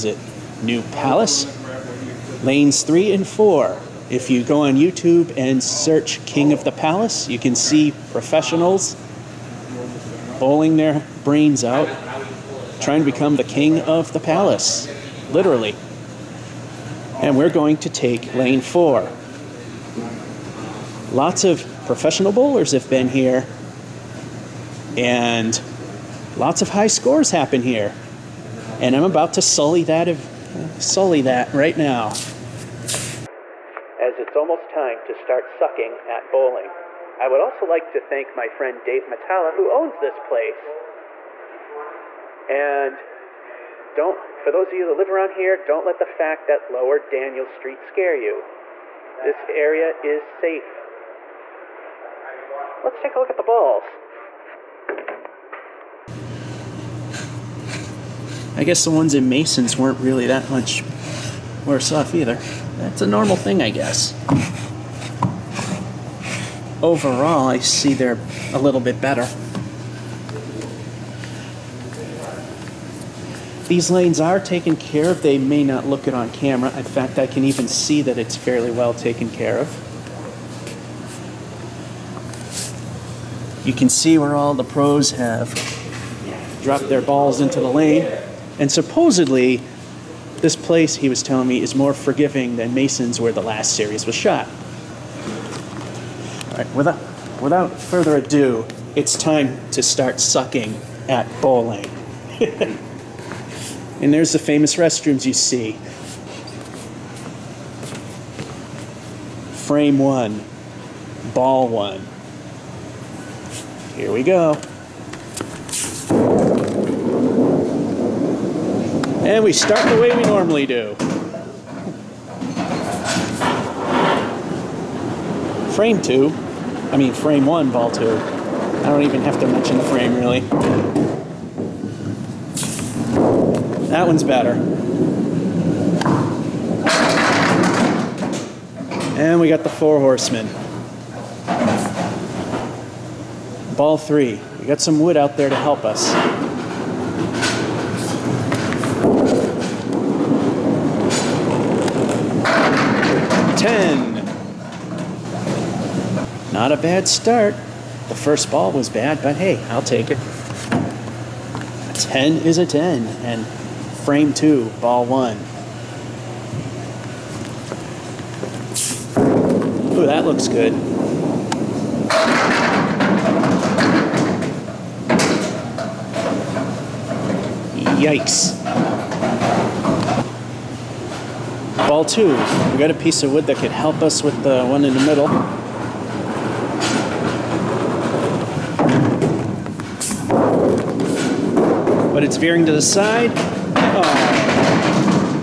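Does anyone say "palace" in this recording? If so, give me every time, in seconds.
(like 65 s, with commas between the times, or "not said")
0 s, 6 s, 14 s.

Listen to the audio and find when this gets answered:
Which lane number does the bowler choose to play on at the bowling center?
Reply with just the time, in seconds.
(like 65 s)
18 s.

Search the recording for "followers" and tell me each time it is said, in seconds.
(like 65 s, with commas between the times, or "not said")
not said.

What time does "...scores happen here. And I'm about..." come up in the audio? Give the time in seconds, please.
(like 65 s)
26 s.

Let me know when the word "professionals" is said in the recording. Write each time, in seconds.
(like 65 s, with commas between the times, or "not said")
8 s, 21 s.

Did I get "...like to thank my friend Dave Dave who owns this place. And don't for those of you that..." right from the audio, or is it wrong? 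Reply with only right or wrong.
wrong.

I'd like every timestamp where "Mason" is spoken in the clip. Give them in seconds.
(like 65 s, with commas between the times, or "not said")
59 s, 92 s.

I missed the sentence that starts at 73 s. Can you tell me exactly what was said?
These lanes are taken care of.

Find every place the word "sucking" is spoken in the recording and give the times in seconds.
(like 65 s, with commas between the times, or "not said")
35 s, 100 s.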